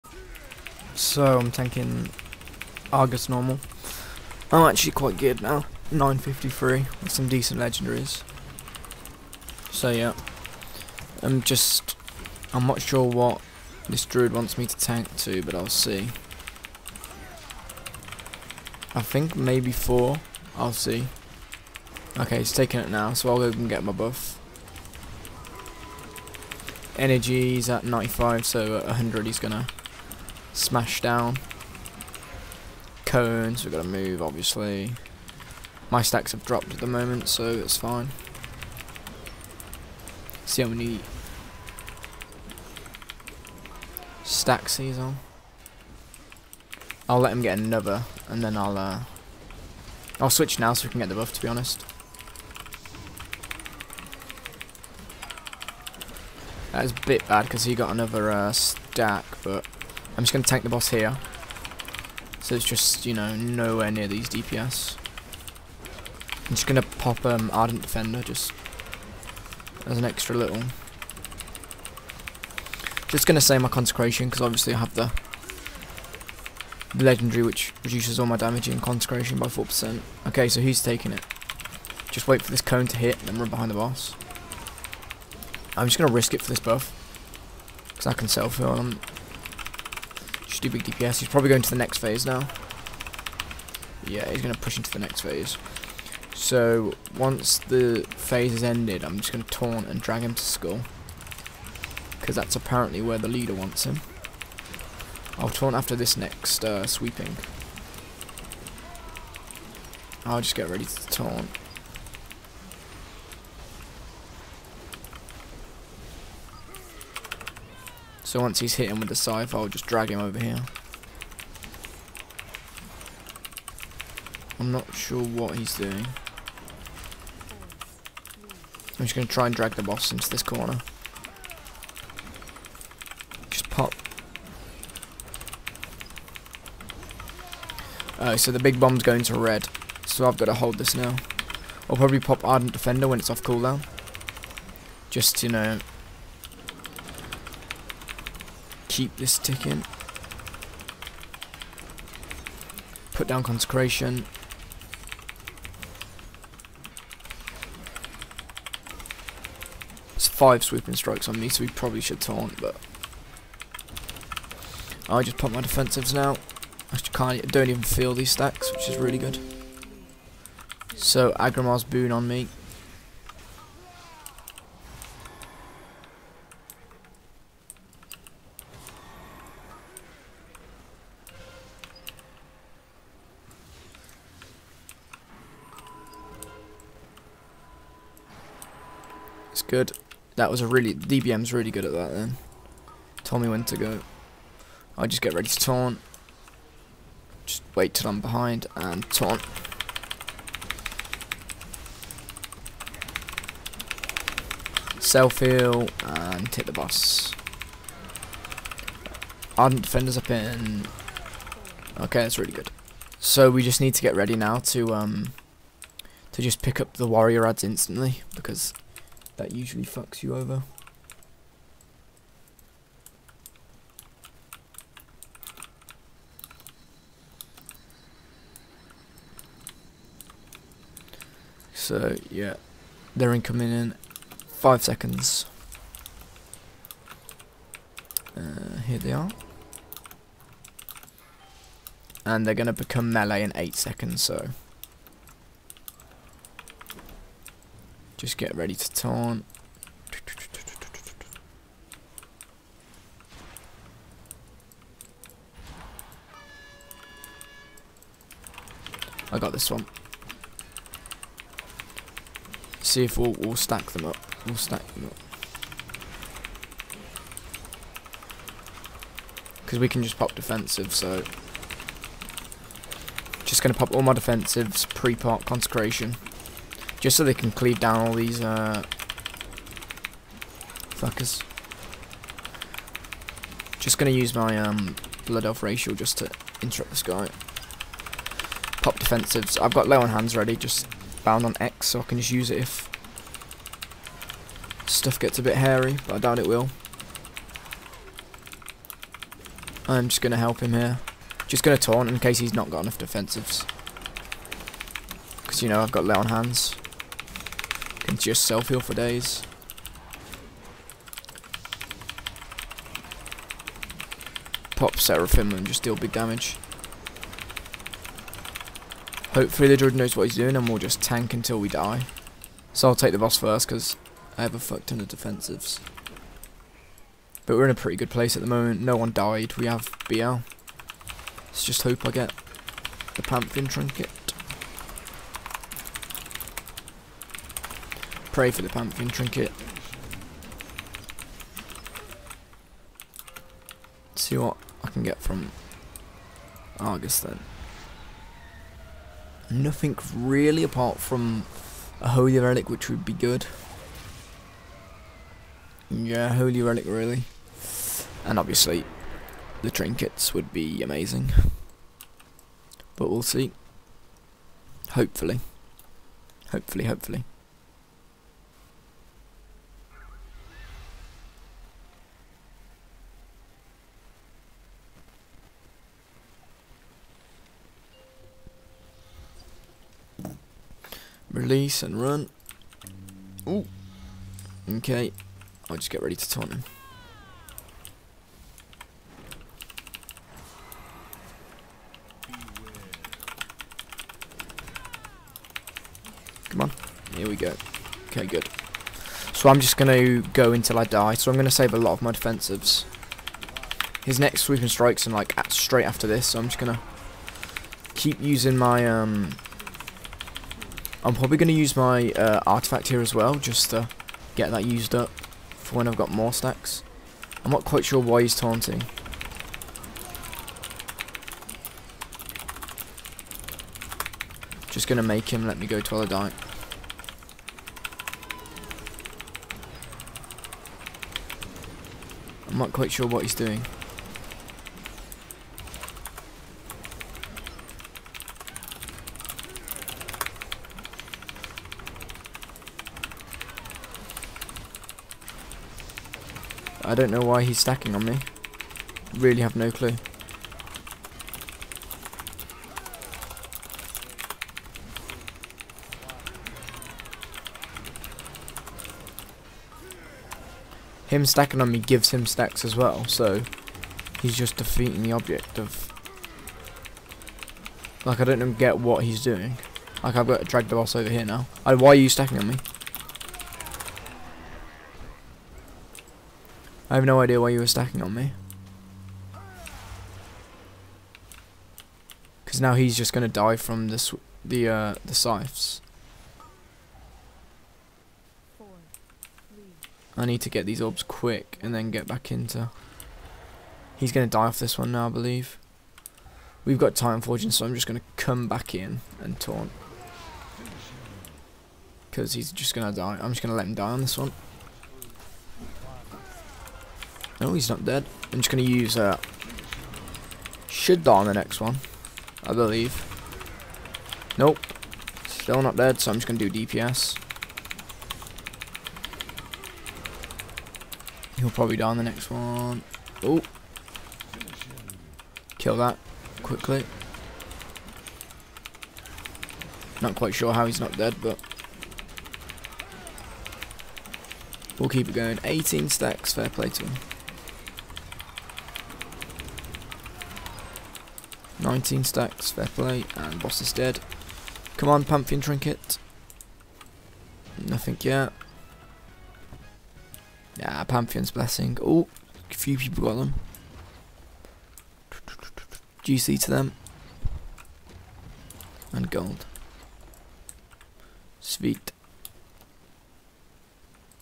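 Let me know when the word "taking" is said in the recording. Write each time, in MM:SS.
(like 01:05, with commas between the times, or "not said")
00:22, 01:20.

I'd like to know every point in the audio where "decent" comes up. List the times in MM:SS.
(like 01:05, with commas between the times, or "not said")
00:07.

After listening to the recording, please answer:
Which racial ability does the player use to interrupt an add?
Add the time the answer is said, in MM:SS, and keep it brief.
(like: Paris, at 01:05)
Blood elf racial, at 04:45.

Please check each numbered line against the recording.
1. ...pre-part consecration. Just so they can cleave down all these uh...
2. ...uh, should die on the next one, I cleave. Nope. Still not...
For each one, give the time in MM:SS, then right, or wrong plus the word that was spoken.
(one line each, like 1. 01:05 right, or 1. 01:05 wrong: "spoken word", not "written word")
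1. 04:34 right
2. 08:28 wrong: "believe", not "cleave".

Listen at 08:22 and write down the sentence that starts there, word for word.
Because he's just going to die.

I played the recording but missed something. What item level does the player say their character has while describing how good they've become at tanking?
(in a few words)
953.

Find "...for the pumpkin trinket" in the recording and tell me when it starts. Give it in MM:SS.
05:38.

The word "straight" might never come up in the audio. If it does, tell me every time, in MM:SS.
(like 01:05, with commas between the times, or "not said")
06:45.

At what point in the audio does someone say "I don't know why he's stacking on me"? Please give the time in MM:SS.
07:26.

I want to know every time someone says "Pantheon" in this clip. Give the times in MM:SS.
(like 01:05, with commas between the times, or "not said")
05:33, 09:05, 09:10.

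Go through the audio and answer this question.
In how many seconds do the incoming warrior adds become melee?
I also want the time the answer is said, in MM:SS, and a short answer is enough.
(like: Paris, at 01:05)
8, at 04:03.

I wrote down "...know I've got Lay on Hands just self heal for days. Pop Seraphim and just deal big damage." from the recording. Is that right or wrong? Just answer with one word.
right.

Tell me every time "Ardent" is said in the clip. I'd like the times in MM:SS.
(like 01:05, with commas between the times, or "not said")
01:07, 02:22, 03:29.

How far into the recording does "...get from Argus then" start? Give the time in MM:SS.
05:45.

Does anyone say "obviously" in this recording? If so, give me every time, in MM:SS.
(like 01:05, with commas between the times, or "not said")
00:34, 01:14, 05:58.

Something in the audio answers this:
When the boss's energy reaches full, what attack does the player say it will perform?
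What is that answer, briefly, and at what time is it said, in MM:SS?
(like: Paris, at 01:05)
Smash, at 00:30.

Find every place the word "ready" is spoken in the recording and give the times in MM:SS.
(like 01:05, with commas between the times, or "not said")
01:50, 03:15, 03:34, 04:08, 04:50, 06:26.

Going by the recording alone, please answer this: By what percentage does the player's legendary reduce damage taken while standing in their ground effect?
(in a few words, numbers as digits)
4%.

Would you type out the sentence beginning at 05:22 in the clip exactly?
So I'll take the boss first because I have a fuck ton of defensives.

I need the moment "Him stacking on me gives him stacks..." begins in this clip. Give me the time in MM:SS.
07:41.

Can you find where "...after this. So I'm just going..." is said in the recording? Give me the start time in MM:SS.
06:45.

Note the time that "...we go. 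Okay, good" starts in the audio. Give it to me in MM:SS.
06:37.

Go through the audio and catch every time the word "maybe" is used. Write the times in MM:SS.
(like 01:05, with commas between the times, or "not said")
00:19.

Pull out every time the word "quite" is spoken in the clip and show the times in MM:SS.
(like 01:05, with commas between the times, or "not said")
00:04, 06:57, 07:12, 08:50.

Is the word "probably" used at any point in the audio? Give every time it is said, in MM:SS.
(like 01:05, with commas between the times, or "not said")
01:31, 02:21, 02:41, 06:51, 08:41.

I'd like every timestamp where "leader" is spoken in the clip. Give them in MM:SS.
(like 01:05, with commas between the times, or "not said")
01:43.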